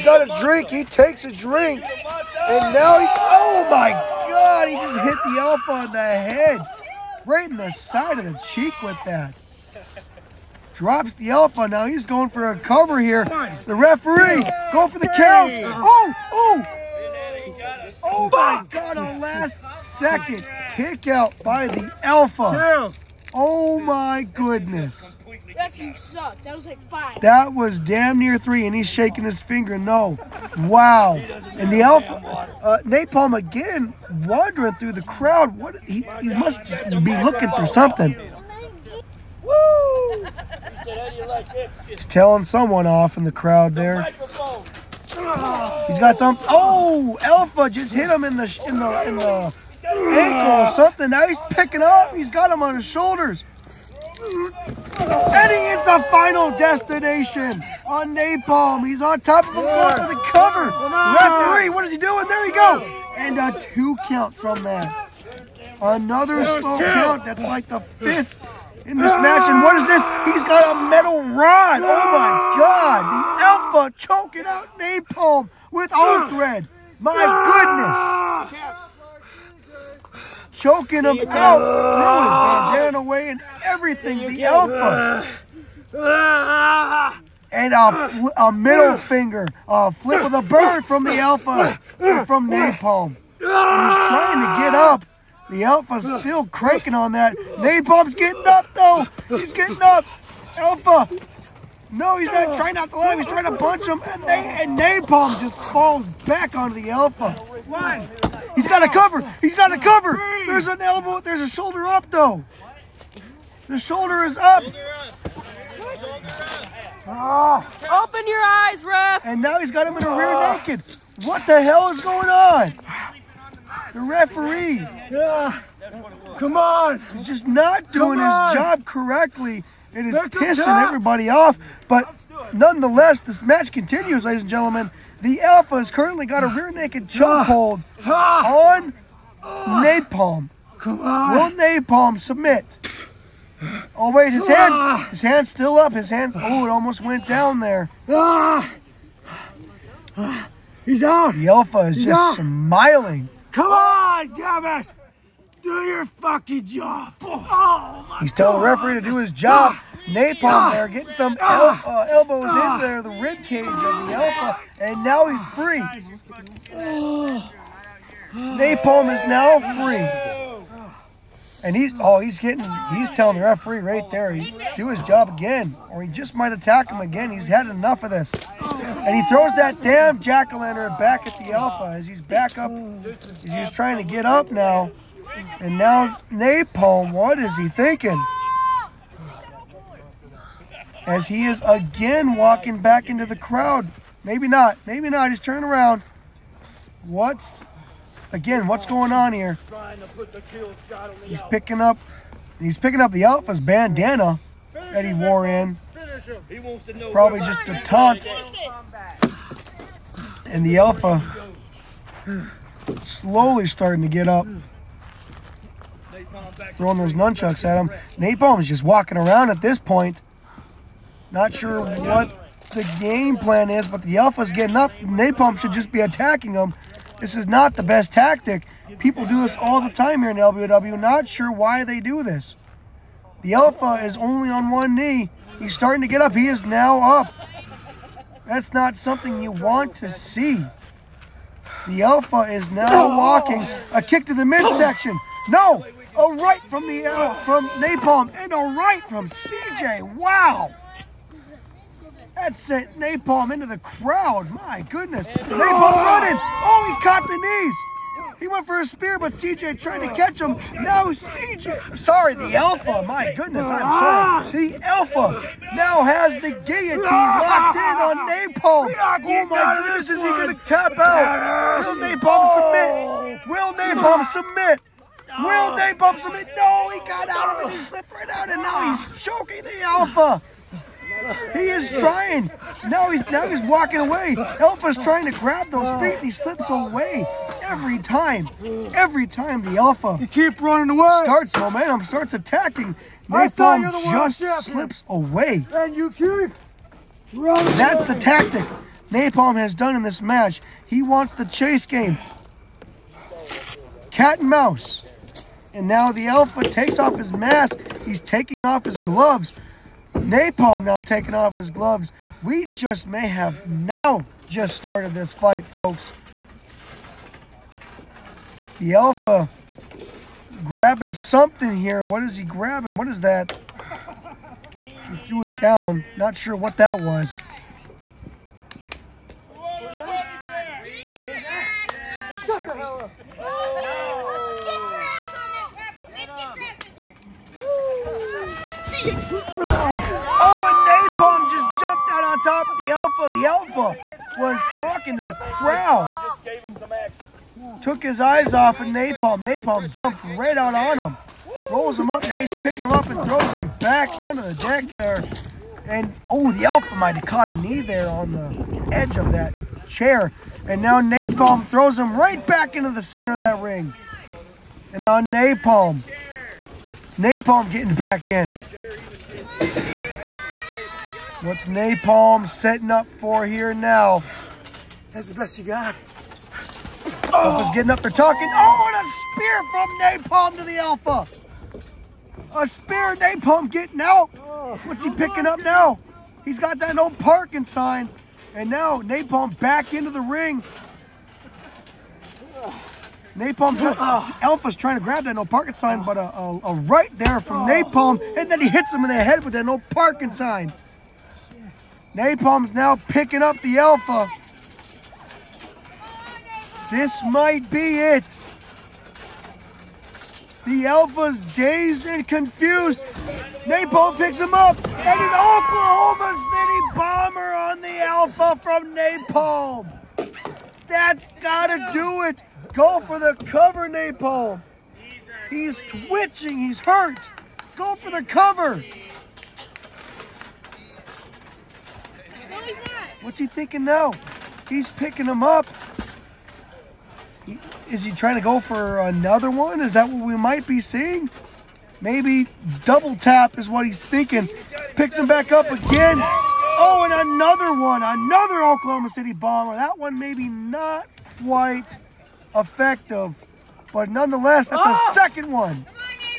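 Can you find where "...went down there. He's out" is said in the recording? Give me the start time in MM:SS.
02:27.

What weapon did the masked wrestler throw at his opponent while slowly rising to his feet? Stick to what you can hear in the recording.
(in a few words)
Nunchucks.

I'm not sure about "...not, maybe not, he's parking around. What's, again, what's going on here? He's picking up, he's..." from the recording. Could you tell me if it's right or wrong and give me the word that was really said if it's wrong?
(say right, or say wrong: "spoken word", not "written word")
wrong: "turning", not "parking".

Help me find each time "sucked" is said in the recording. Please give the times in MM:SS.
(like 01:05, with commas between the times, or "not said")
00:25.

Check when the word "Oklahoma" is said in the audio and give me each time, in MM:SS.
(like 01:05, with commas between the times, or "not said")
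06:55, 07:28.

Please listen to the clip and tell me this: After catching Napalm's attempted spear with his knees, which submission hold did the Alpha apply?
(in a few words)
Guillotine.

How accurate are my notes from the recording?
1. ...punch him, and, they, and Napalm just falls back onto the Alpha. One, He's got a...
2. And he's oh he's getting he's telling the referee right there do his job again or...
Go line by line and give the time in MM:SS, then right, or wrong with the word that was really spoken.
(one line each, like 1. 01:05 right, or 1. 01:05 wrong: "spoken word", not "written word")
1. 01:43 right
2. 02:51 right.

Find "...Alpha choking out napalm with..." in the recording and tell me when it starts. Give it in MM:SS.
01:13.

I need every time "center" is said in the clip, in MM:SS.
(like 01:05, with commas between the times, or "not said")
06:03.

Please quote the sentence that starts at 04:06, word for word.
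a oh, right from the uh, from Napalm, and a right from CJ.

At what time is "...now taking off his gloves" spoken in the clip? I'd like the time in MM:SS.
05:10.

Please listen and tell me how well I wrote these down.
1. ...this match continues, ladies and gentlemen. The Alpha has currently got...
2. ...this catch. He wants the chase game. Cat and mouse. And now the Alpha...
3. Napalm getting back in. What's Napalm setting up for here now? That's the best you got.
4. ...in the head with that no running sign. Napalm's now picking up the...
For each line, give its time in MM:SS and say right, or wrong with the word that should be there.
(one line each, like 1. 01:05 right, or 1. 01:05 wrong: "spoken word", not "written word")
1. 02:13 right
2. 05:00 wrong: "match", not "catch"
3. 06:07 right
4. 06:39 wrong: "parking", not "running".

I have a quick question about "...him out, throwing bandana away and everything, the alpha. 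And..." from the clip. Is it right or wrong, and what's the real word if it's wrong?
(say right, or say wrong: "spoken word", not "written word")
right.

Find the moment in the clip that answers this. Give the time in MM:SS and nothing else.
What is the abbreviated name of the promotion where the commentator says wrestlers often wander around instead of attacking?
03:50.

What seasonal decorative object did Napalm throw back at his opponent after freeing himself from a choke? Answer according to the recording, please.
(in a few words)
Jack o' lantern.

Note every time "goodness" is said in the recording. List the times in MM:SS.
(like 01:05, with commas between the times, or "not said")
00:24, 01:17, 04:14, 04:23, 04:29.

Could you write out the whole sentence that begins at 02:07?
He's just not doing his job correctly.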